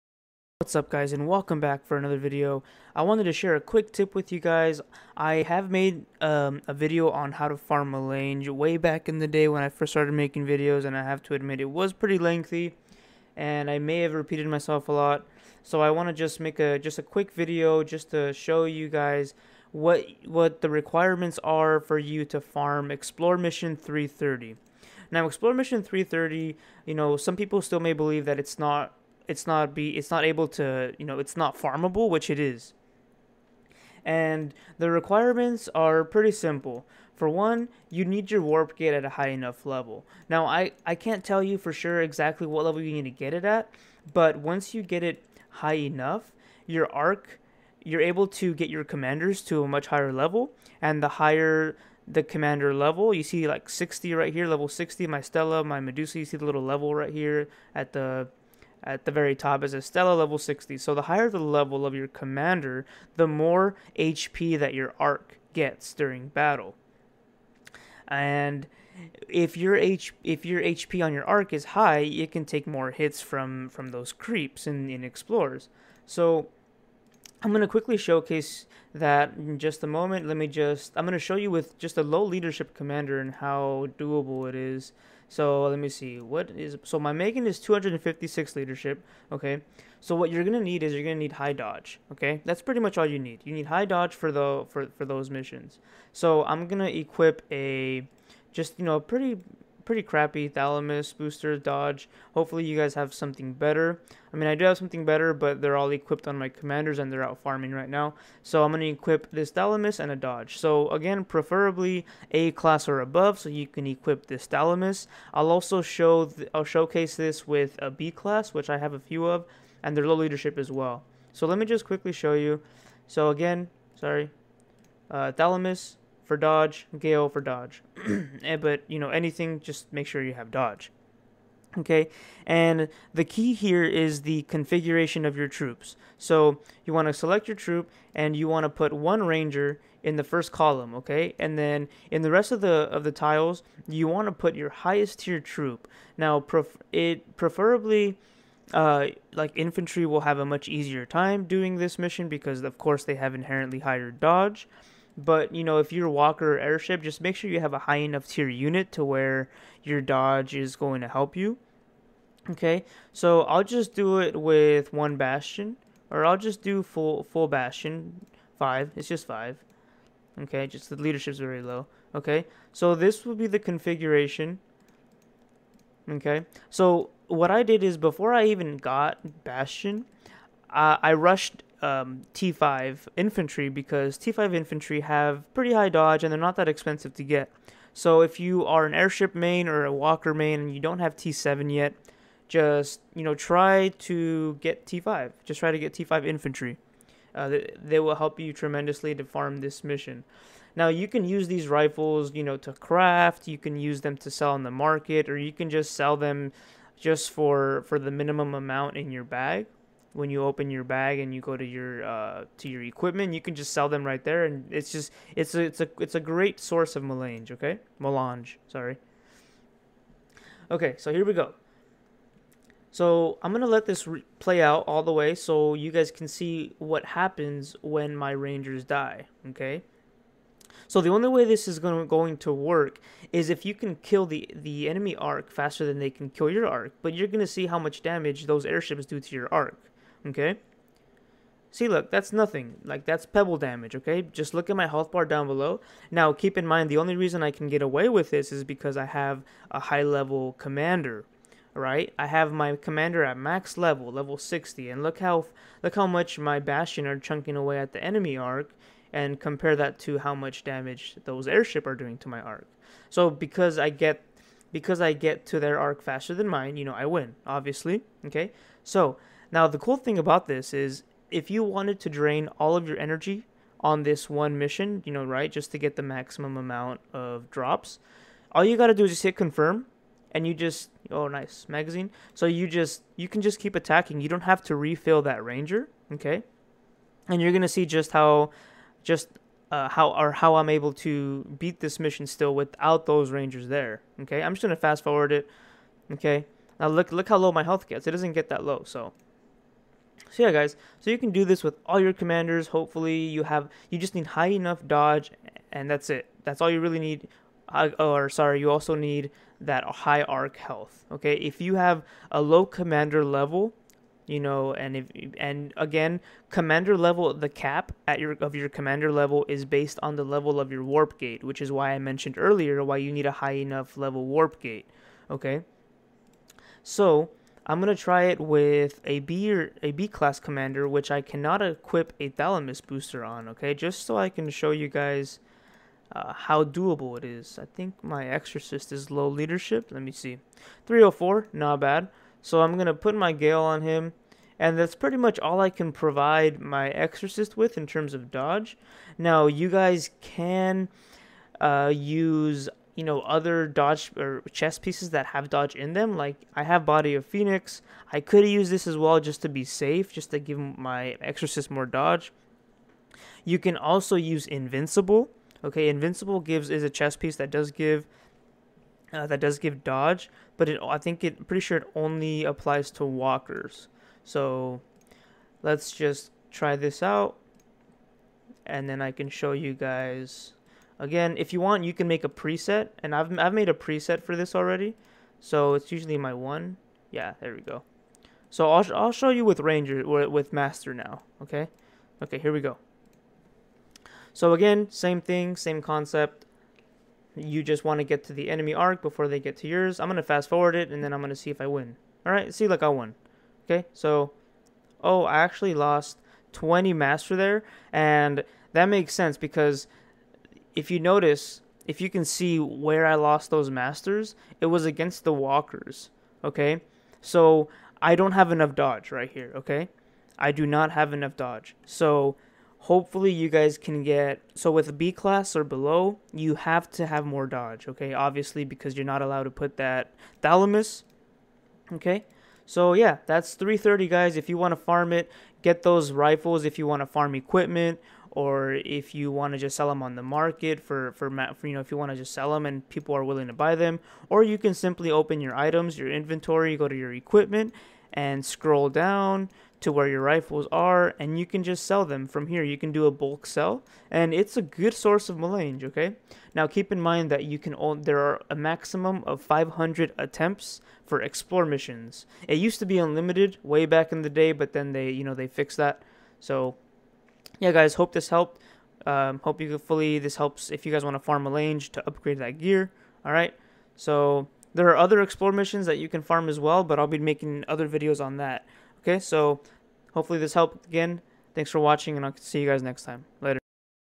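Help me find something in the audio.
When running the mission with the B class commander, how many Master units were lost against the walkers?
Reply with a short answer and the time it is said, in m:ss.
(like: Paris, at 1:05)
20, at 6:46.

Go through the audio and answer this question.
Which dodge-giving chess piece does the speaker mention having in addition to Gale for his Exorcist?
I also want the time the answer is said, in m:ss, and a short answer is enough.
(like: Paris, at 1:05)
body of phoenix, at 5:56.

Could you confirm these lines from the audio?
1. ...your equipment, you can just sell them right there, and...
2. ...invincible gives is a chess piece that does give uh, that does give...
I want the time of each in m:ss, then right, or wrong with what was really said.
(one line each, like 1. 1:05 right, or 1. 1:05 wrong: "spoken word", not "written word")
1. 3:32 right
2. 6:05 right.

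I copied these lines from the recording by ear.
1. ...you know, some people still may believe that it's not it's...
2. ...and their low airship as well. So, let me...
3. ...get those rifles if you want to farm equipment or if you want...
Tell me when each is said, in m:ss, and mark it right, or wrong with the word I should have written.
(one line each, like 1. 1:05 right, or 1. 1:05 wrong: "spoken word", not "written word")
1. 0:26 right
2. 1:59 wrong: "leadership", not "airship"
3. 7:15 right.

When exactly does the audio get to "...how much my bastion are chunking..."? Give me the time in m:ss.
4:15.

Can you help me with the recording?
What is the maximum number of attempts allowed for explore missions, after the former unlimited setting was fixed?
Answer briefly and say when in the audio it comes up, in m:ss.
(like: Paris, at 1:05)
500, at 7:39.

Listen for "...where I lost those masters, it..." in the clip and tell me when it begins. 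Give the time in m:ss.
6:52.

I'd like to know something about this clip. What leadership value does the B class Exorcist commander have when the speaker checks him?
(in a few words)
304.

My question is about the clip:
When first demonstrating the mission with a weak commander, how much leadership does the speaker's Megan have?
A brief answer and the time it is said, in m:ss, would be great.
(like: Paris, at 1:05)
256, at 1:27.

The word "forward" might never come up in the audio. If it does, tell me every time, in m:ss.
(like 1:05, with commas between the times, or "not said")
4:55, 6:40.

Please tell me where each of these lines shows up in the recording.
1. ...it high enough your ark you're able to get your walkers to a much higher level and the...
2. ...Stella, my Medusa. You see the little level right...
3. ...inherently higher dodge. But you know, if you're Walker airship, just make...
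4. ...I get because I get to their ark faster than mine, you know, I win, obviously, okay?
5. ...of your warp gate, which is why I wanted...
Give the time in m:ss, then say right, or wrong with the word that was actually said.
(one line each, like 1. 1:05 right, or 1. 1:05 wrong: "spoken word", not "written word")
1. 0:45 wrong: "commanders", not "walkers"
2. 0:55 right
3. 2:33 right
4. 4:23 right
5. 5:20 wrong: "mentioned", not "wanted".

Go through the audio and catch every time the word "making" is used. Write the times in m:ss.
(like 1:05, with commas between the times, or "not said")
0:10, 7:57.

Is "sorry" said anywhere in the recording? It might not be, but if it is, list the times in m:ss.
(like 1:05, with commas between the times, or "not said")
2:03, 3:38, 5:08.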